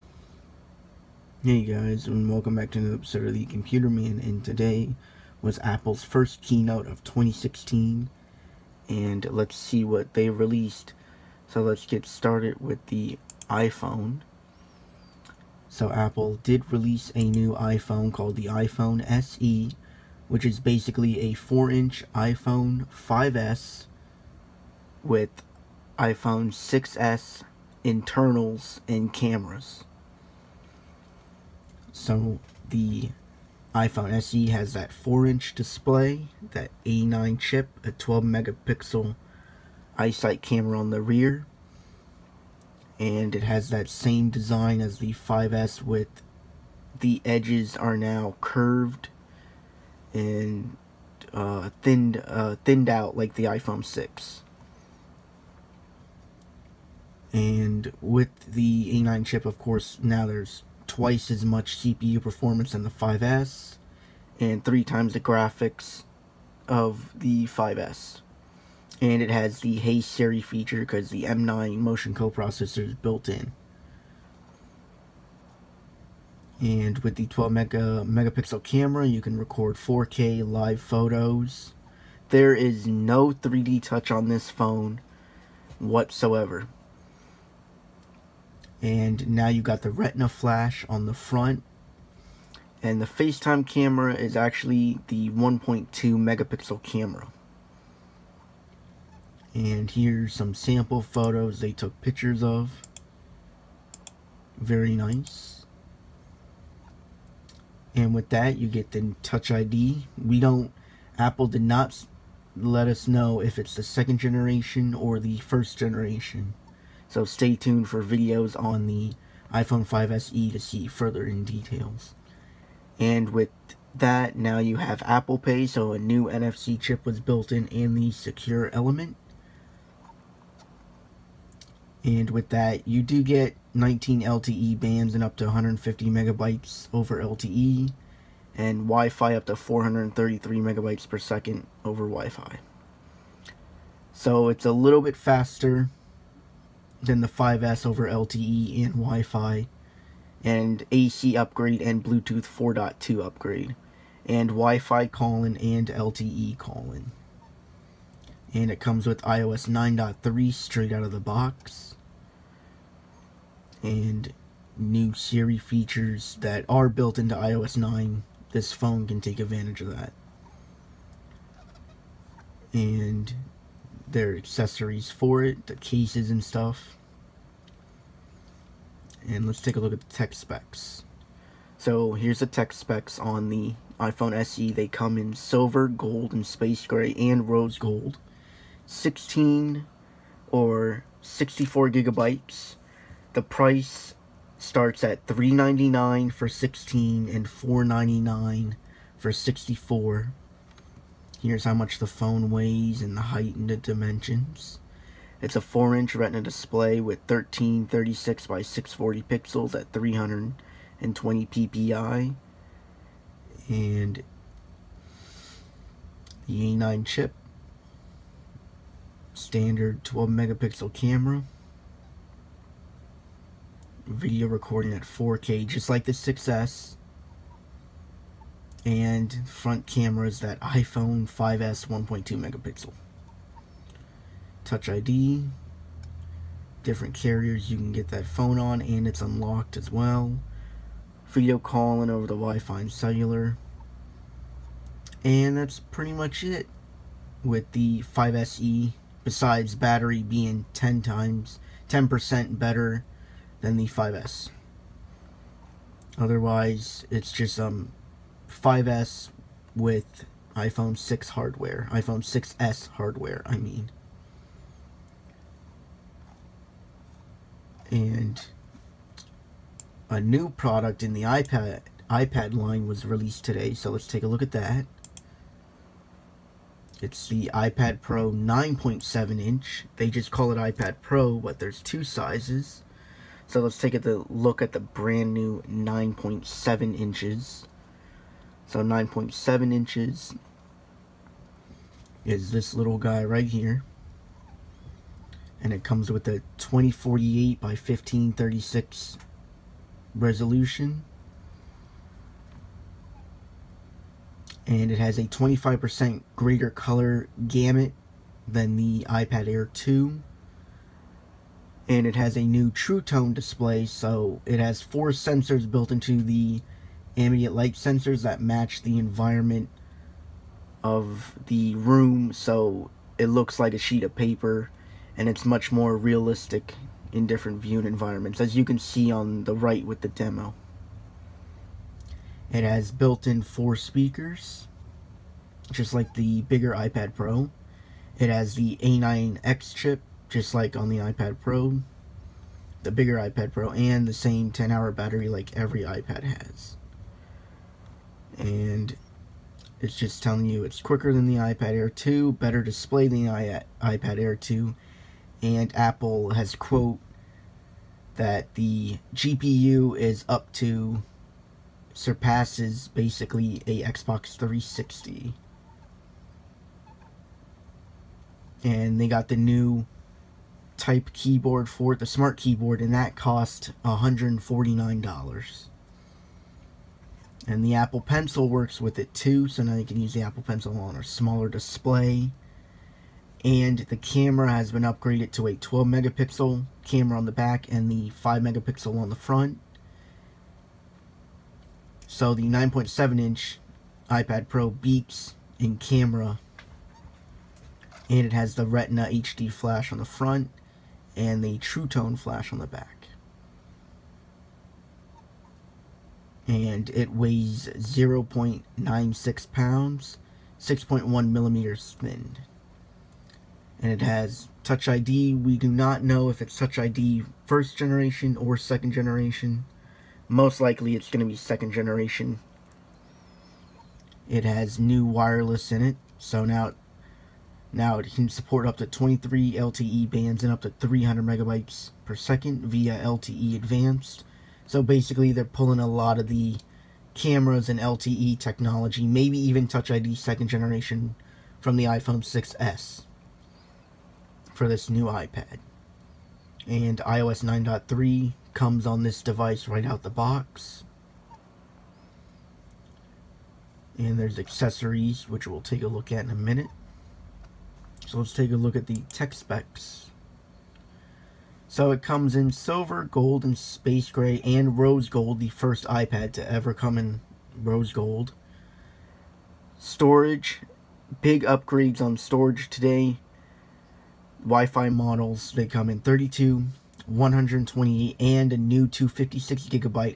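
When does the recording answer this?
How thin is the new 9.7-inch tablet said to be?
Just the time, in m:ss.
6:50.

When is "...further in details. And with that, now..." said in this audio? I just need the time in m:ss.
2:00.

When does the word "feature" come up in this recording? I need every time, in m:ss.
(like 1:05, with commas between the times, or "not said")
1:10, 2:45.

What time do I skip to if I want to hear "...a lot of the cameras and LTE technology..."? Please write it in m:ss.
7:15.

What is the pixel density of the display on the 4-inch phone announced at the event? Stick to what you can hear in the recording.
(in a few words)
320 ppi.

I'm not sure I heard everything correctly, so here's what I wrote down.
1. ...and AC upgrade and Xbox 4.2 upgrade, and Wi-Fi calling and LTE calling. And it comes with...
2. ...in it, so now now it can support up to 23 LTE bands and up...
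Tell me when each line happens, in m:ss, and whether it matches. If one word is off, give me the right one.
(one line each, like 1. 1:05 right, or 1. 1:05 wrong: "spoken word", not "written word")
1. 2:30 wrong: "Bluetooth", not "Xbox"
2. 7:05 right.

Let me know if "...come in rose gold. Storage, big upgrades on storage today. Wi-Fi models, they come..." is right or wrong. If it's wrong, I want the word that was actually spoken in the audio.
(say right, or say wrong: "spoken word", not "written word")
right.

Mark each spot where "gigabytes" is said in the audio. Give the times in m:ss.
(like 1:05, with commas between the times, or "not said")
3:11, 7:59.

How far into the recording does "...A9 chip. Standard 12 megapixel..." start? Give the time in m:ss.
3:36.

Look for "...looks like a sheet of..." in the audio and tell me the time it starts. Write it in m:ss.
5:23.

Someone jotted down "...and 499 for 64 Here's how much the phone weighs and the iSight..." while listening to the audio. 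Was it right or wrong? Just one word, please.
wrong.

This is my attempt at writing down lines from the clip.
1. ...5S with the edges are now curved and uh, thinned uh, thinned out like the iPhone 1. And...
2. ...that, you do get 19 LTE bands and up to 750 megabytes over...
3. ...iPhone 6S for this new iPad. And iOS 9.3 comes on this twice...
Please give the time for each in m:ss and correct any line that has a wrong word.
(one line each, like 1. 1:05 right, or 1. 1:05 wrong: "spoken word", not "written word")
1. 0:45 wrong: "6", not "1"
2. 2:12 wrong: "150", not "750"
3. 7:21 wrong: "device", not "twice".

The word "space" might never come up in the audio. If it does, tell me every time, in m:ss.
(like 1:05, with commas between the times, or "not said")
3:06, 7:43.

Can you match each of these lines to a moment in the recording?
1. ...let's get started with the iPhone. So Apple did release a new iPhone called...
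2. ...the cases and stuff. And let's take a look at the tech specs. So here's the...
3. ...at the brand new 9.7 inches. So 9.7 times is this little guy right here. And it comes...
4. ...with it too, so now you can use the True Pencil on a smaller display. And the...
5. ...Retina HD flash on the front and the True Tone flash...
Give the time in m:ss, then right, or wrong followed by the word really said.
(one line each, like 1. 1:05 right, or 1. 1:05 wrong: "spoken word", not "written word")
1. 0:11 right
2. 2:55 right
3. 4:44 wrong: "inches", not "times"
4. 6:18 wrong: "Apple", not "True"
5. 6:38 right.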